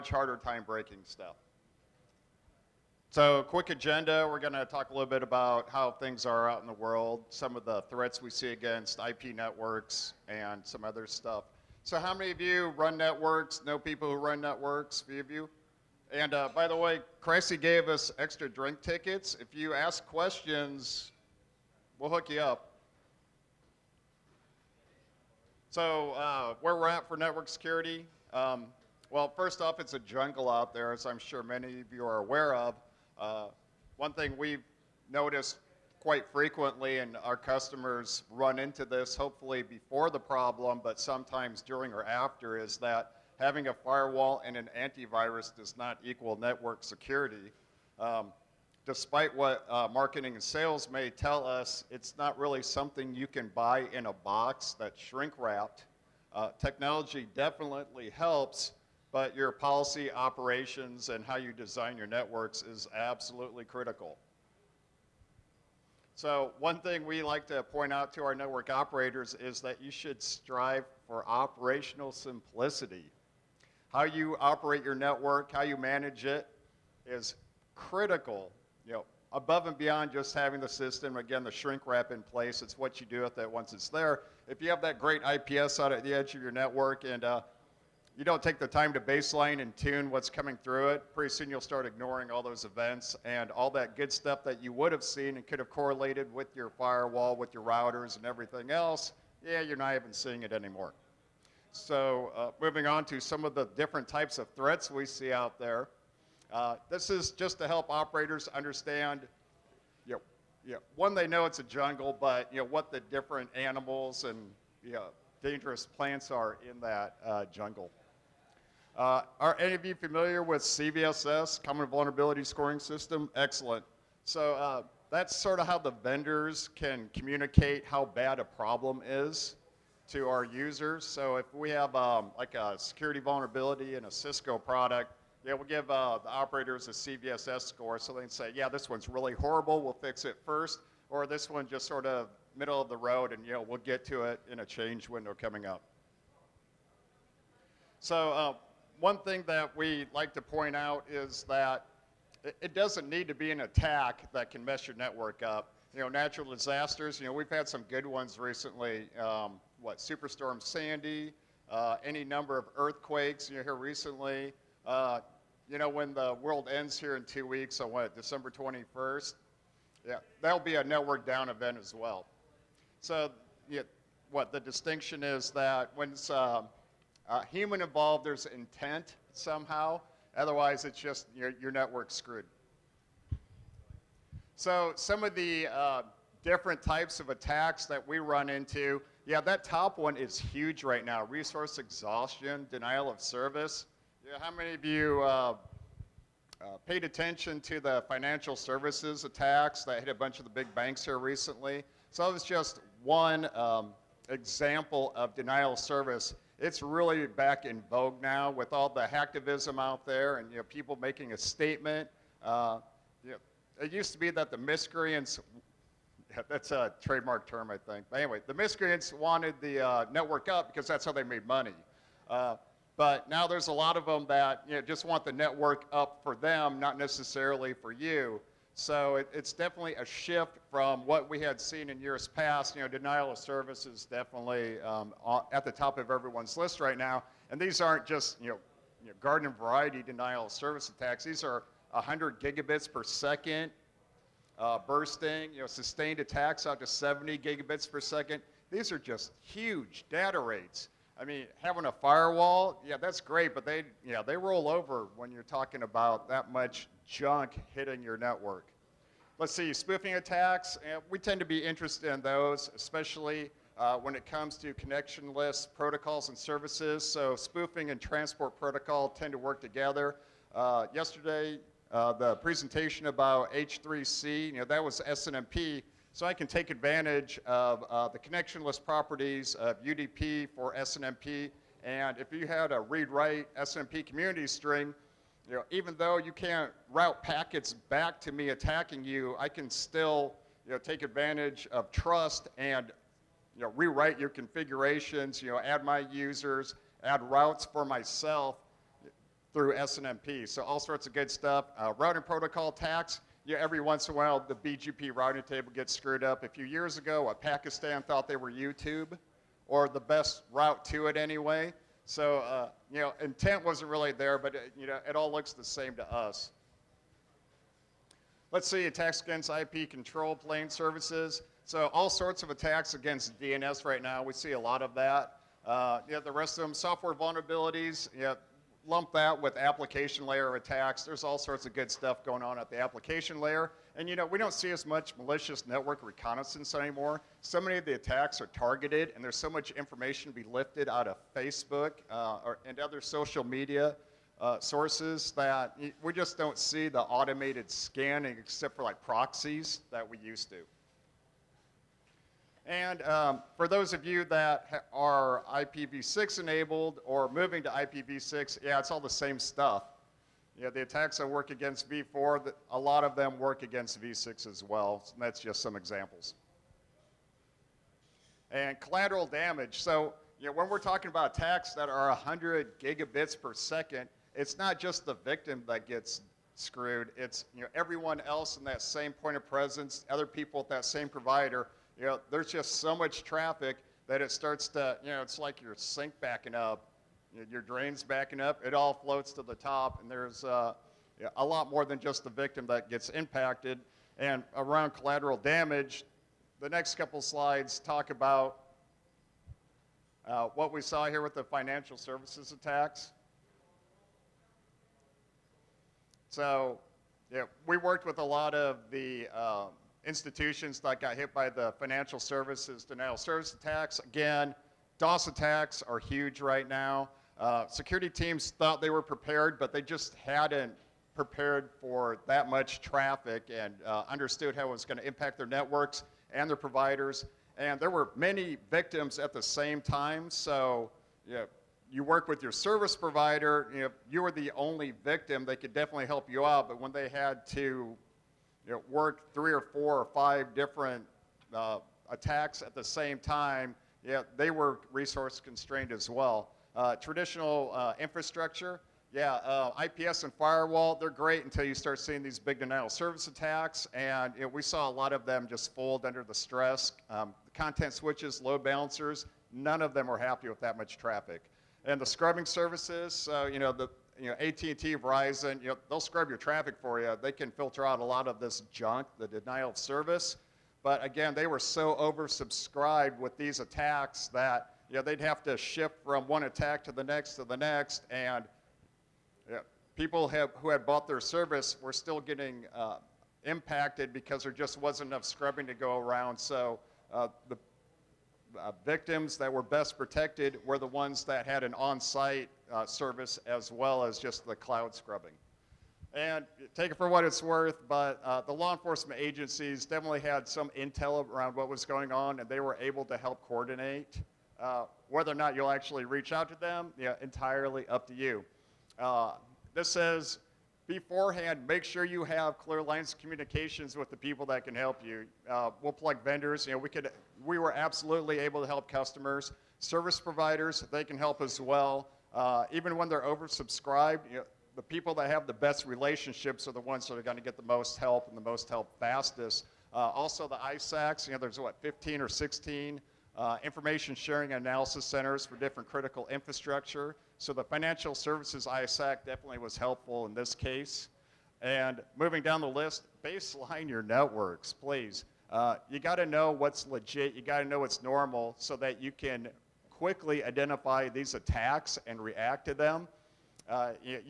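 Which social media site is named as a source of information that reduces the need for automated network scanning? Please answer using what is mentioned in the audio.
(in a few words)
Facebook.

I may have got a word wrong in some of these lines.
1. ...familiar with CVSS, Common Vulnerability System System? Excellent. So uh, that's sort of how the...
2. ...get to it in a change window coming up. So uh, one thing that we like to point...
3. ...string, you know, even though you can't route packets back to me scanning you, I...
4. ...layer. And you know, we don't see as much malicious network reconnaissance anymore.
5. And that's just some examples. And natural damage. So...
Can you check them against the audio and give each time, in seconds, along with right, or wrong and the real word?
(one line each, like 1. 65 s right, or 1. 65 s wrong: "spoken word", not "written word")
1. 119 s wrong: "Scoring", not "System"
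2. 143 s right
3. 284 s wrong: "attacking", not "scanning"
4. 333 s right
5. 365 s wrong: "collateral", not "natural".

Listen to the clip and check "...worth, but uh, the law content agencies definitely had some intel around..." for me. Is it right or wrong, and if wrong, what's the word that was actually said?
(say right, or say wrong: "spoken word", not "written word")
wrong: "enforcement", not "content".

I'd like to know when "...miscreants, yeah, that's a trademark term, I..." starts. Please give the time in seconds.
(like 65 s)
214 s.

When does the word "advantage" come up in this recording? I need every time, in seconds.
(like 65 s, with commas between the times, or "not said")
276 s, 291 s.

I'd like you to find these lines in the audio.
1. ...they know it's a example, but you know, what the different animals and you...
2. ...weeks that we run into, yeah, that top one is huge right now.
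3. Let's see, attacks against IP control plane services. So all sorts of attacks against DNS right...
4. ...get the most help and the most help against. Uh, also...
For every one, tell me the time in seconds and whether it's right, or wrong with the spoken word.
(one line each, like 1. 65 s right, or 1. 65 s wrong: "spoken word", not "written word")
1. 111 s wrong: "jungle", not "example"
2. 187 s wrong: "attacks", not "weeks"
3. 318 s right
4. 527 s wrong: "fastest", not "against".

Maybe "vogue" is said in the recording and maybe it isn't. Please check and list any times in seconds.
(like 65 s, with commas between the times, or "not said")
207 s.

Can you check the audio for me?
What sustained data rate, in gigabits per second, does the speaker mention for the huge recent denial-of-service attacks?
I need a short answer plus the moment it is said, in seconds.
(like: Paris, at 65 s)
70 gigabits per second, at 246 s.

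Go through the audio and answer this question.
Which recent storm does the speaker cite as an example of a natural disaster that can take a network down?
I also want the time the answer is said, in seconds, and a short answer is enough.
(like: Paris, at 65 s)
Superstorm Sandy, at 159 s.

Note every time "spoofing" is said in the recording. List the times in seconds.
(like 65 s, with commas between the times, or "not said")
259 s, 267 s.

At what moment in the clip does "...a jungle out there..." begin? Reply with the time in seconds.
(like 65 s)
29 s.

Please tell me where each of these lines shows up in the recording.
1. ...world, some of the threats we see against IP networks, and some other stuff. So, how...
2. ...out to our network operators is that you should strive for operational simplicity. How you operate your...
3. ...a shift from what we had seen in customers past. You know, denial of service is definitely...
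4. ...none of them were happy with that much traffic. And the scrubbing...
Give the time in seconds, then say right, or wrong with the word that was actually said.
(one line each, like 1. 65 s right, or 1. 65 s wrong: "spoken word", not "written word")
1. 6 s right
2. 67 s right
3. 229 s wrong: "years", not "customers"
4. 459 s right.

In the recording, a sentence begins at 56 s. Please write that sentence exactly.
Uh, technology definitely helps, but your policy operations and how you design your networks is absolutely critical.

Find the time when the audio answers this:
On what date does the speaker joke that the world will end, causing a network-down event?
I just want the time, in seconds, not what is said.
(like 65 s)
168 s.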